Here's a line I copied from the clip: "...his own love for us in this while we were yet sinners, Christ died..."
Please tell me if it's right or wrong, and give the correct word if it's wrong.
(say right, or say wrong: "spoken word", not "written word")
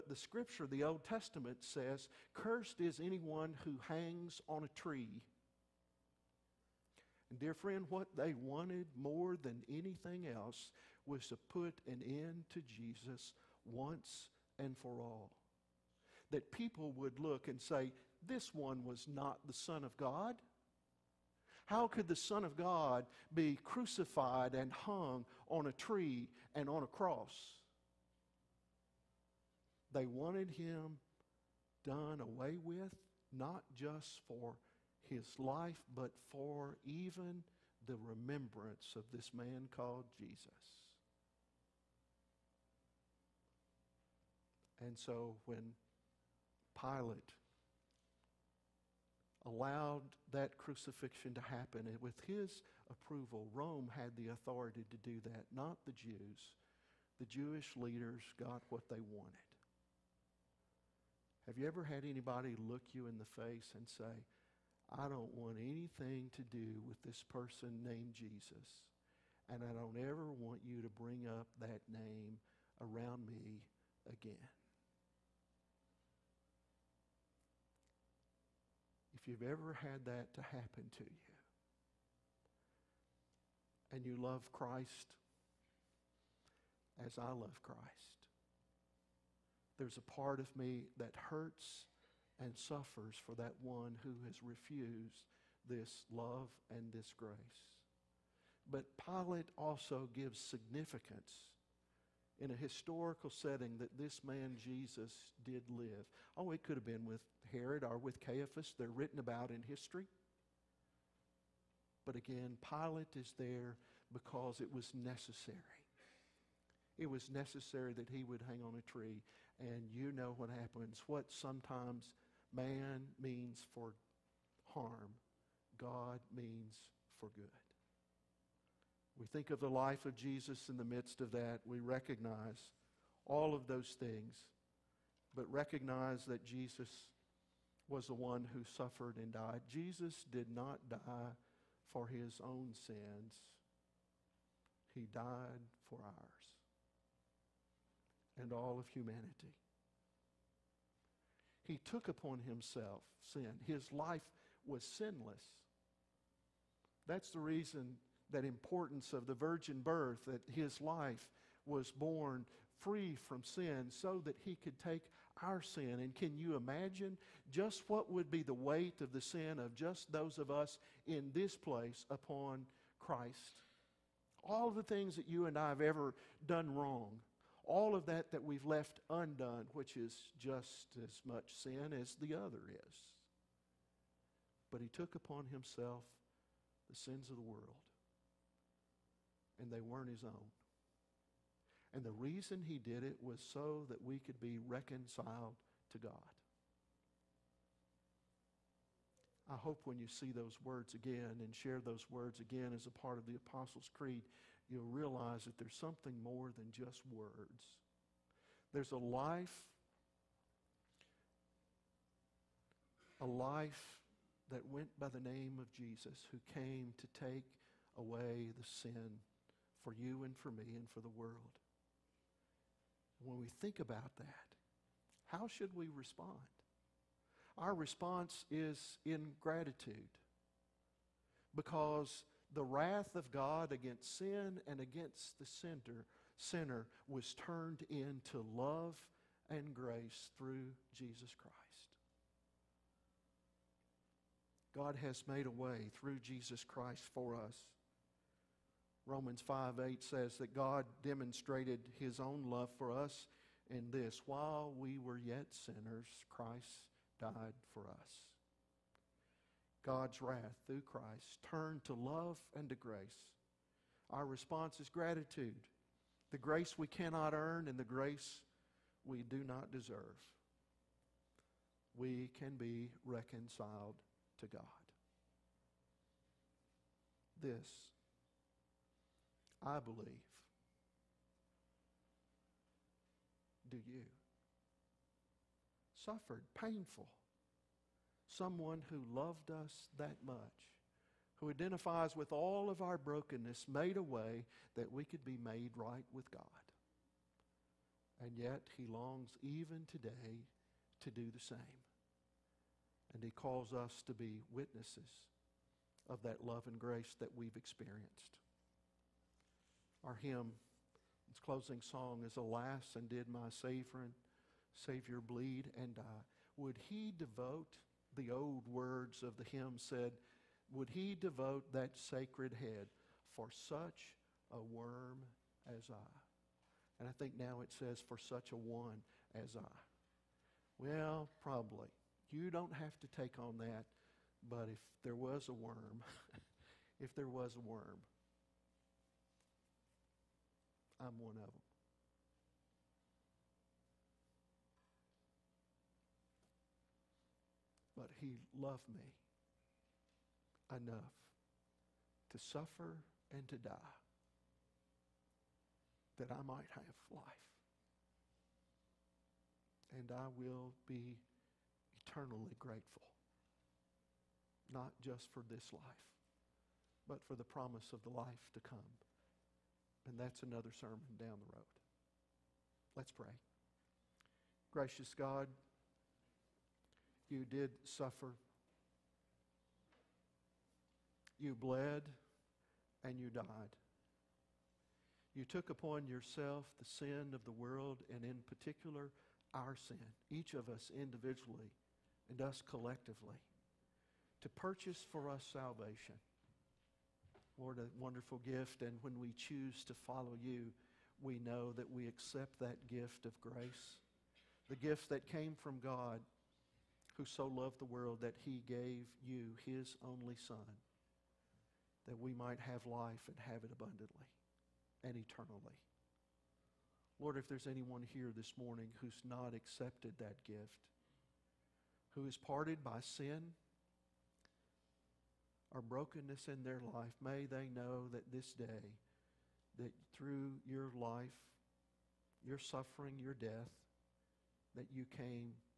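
right.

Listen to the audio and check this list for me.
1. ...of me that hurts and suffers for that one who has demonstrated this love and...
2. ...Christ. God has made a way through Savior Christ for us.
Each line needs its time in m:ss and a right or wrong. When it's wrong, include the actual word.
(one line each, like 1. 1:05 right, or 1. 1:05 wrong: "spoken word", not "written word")
1. 1:30 wrong: "refused", not "demonstrated"
2. 4:01 wrong: "Jesus", not "Savior".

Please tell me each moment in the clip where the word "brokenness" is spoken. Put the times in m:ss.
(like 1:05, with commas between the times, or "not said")
4:52, 7:05.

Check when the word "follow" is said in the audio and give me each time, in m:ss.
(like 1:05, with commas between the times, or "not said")
6:40.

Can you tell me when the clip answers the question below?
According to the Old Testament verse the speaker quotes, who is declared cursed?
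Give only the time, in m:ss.
0:02.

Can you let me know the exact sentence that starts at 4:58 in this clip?
And yet, He longs even today to do the same.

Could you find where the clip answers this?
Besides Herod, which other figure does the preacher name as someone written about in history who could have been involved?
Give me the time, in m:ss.
1:48.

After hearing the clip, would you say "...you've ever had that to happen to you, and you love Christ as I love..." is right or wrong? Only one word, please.
right.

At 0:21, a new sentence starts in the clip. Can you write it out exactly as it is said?
How could the Son of God be crucified and hung on a tree and on a cross?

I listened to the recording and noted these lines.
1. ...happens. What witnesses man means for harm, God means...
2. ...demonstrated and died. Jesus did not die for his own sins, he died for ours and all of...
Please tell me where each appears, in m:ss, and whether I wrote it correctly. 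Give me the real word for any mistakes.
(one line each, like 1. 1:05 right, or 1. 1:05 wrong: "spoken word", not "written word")
1. 2:00 wrong: "sometimes", not "witnesses"
2. 2:18 wrong: "suffered", not "demonstrated".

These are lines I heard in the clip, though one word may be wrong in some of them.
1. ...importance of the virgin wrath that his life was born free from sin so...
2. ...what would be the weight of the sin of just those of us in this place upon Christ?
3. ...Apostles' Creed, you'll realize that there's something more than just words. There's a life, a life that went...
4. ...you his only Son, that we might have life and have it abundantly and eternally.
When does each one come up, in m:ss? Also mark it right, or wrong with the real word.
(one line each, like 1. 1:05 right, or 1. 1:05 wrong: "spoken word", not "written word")
1. 2:38 wrong: "birth", not "wrath"
2. 2:47 right
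3. 3:23 right
4. 6:49 right.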